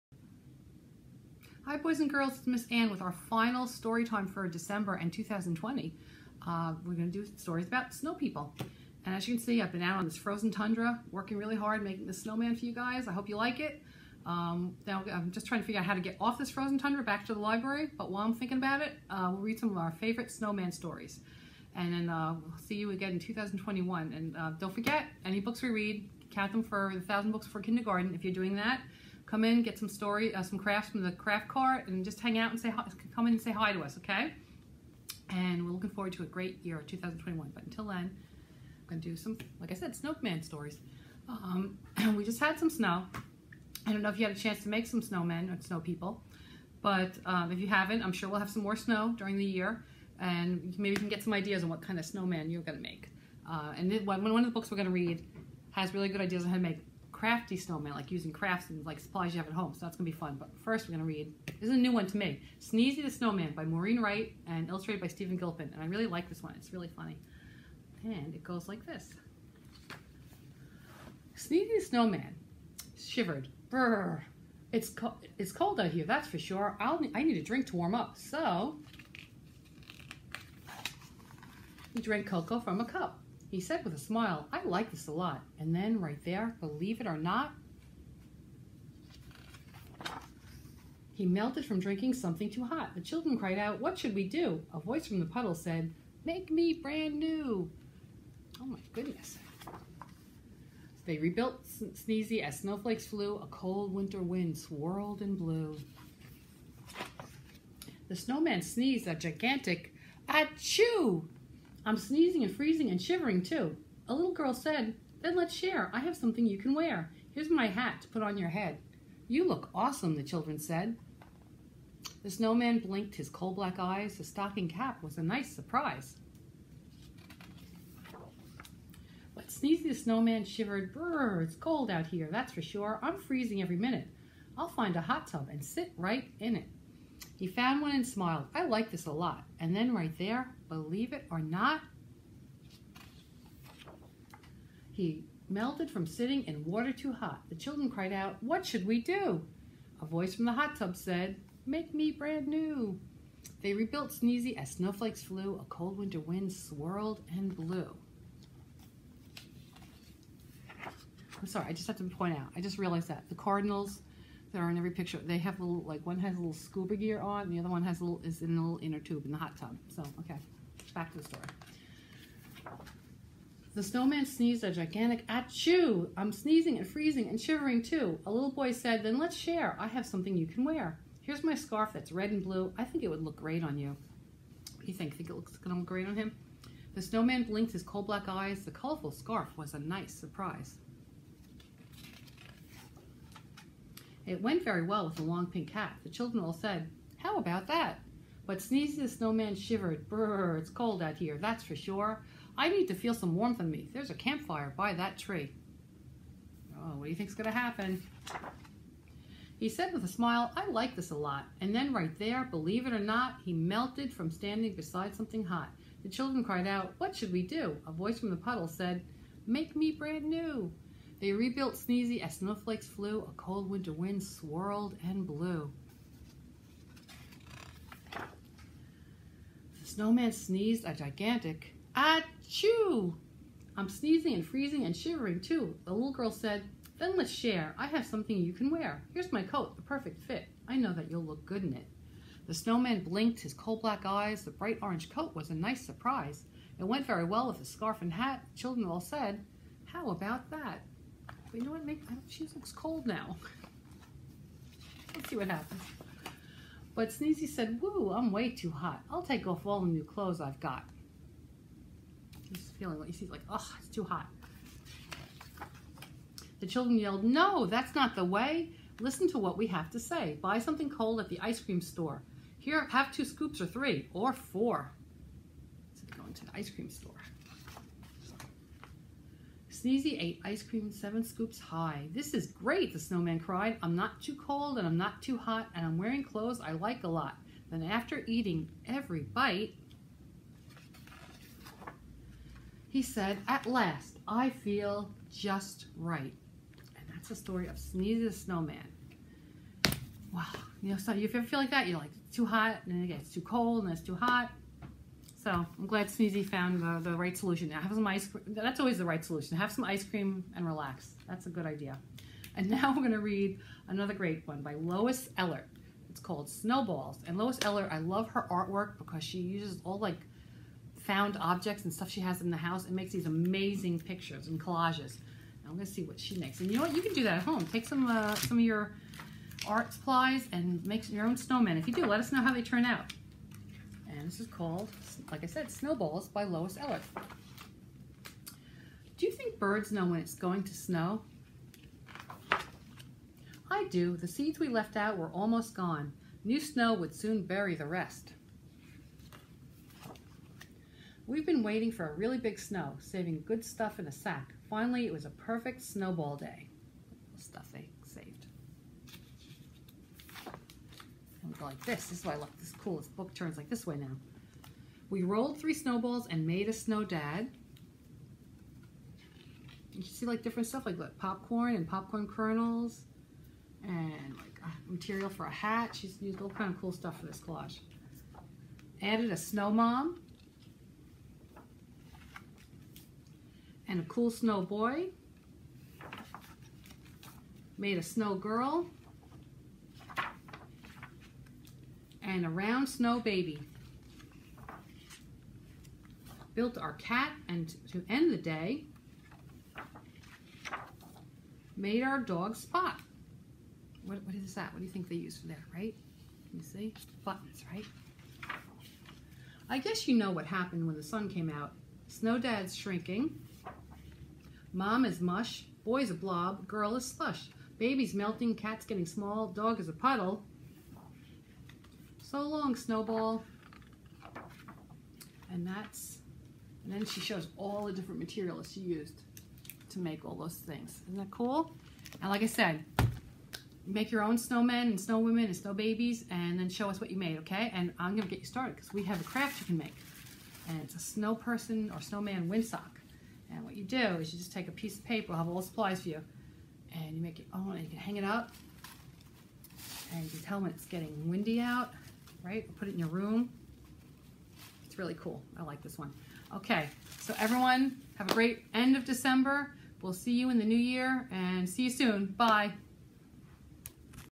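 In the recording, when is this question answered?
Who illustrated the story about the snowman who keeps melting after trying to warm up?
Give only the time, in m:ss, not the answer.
1:05.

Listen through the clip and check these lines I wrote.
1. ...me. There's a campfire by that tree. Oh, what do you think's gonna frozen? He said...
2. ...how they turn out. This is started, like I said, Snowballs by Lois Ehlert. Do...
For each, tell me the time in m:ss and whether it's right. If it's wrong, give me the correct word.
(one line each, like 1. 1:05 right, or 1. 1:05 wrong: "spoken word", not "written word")
1. 3:23 wrong: "happen", not "frozen"
2. 5:32 wrong: "called", not "started".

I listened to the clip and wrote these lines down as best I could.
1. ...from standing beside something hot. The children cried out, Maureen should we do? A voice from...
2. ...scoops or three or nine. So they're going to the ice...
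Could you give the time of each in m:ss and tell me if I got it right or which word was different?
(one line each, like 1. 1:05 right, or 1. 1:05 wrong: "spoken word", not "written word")
1. 3:34 wrong: "What", not "Maureen"
2. 4:33 wrong: "four", not "nine".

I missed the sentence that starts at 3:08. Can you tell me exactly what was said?
The colorful scarf was a nice surprise.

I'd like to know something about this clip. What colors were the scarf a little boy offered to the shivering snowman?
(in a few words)
Red and blue.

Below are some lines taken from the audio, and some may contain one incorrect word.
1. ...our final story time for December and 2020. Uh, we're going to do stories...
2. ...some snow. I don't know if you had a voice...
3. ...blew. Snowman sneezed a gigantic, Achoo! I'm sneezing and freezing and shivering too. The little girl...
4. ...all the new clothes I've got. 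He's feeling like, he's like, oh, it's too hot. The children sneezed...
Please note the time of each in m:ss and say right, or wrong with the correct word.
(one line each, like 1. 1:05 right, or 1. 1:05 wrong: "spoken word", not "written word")
1. 0:03 right
2. 0:42 wrong: "chance", not "voice"
3. 3:45 right
4. 4:19 wrong: "yelled", not "sneezed".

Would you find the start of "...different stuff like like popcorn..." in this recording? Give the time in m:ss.
6:10.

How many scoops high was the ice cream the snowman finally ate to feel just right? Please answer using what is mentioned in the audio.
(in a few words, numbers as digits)
7.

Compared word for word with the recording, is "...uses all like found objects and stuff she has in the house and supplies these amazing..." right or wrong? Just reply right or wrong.
wrong.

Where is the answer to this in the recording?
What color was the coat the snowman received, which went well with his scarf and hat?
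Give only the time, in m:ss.
4:04.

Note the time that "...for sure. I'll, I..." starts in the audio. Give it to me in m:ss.
1:16.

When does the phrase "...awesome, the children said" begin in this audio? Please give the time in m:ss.
1:59.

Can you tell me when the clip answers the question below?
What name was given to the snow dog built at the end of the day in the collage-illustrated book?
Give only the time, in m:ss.
6:42.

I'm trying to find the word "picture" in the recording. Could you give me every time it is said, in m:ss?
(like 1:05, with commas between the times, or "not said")
2:44, 5:23.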